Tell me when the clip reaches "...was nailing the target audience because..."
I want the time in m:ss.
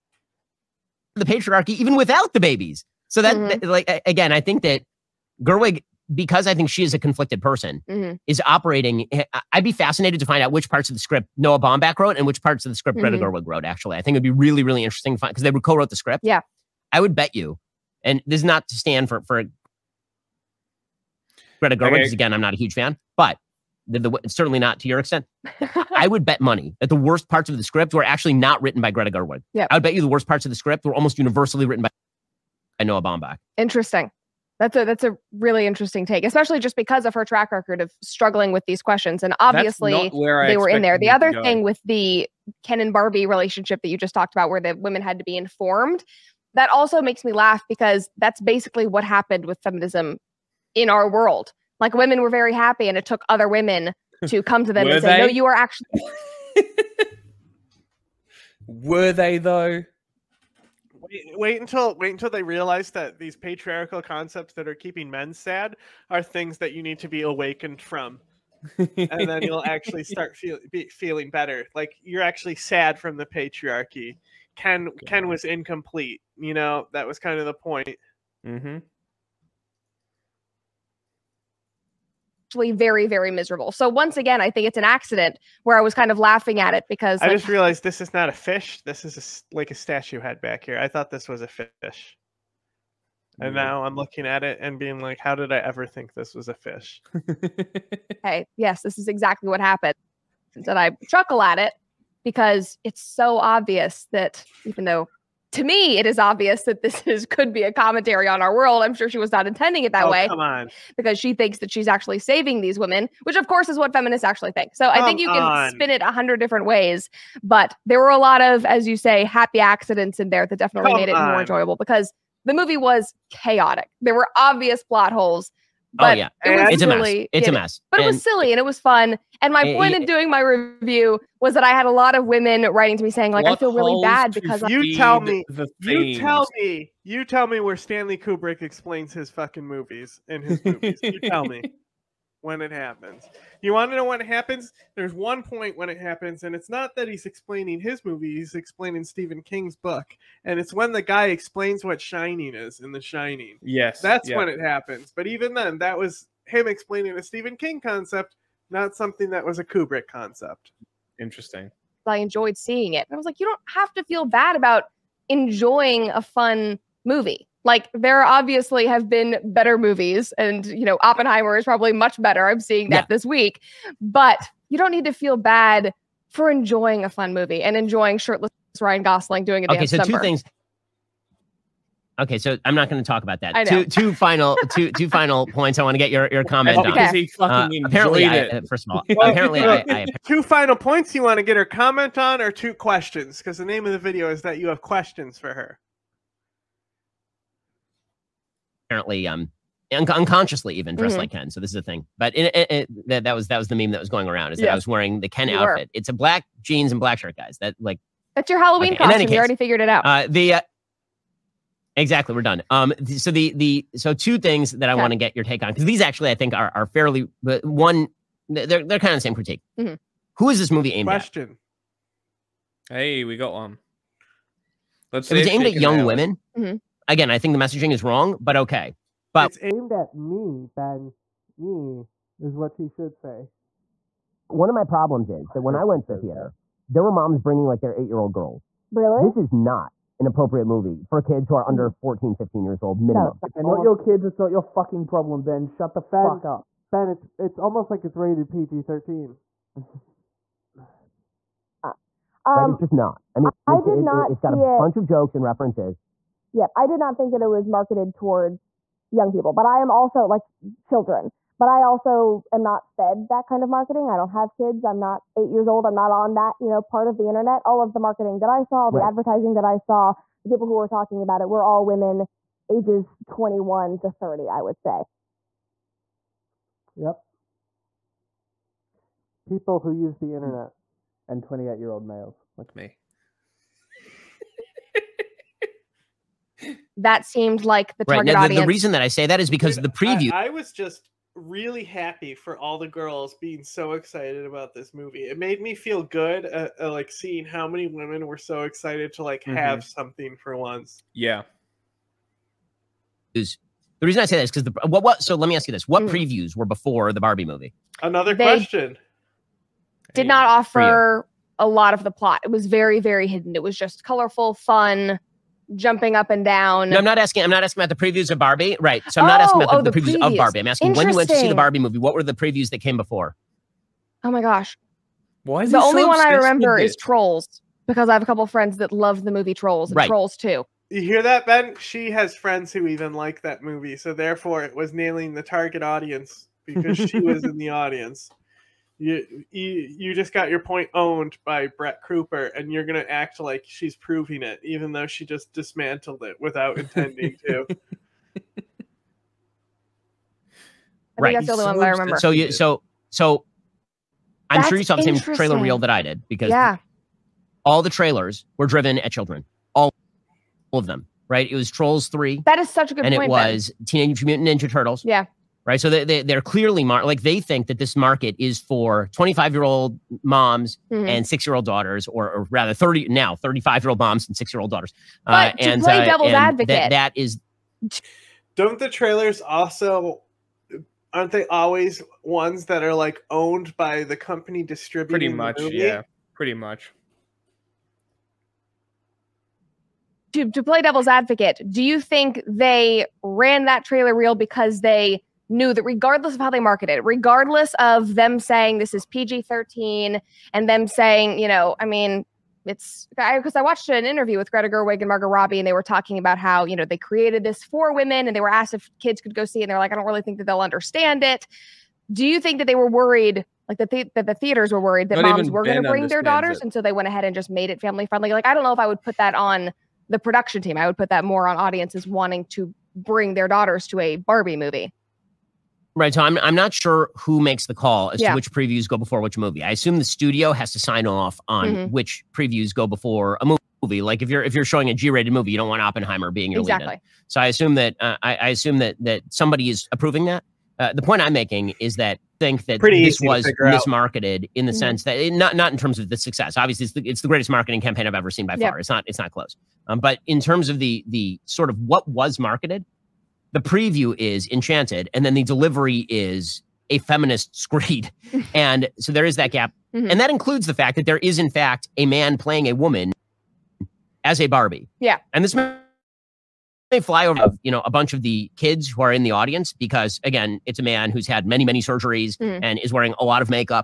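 5:34.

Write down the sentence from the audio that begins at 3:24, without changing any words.
I was wearing the Ken you outfit.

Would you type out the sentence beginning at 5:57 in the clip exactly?
all the trailers were driven at children.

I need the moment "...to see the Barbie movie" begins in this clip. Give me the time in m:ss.
5:21.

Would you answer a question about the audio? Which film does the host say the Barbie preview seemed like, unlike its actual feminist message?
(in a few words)
Enchanted.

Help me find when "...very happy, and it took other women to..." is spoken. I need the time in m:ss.
0:52.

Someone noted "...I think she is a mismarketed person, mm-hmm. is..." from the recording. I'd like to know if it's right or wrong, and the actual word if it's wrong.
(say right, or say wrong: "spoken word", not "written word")
wrong: "conflicted", not "mismarketed".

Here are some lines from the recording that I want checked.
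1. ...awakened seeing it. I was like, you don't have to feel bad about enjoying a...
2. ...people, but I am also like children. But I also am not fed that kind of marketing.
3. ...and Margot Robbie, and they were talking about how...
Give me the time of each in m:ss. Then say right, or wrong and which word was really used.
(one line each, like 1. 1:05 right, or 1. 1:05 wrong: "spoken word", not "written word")
1. 2:42 wrong: "enjoyed", not "awakened"
2. 4:19 right
3. 6:44 right.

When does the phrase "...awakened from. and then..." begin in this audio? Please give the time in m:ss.
1:07.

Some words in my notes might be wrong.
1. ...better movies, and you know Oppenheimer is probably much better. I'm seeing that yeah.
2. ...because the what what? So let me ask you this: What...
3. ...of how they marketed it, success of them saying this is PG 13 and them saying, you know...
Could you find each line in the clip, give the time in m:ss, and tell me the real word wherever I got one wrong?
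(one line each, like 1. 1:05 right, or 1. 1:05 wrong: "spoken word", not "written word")
1. 2:49 right
2. 5:04 right
3. 6:36 wrong: "regardless", not "success".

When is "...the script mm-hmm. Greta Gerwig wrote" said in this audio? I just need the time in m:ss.
0:12.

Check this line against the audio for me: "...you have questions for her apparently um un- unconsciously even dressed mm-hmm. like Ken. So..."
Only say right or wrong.
right.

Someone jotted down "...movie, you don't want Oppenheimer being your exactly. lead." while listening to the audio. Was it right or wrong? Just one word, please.
right.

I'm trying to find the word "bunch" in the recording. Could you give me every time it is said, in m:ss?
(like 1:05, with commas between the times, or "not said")
4:14, 7:47.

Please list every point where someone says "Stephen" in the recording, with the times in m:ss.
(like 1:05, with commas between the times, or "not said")
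2:29, 2:37.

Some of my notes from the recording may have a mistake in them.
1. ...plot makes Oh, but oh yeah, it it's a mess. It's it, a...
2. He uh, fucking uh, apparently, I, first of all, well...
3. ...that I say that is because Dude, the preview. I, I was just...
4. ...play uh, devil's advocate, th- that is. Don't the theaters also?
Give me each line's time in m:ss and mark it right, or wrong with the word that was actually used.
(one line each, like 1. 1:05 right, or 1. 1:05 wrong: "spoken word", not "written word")
1. 2:04 wrong: "holes", not "makes"
2. 3:07 right
3. 4:48 right
4. 6:15 wrong: "trailers", not "theaters".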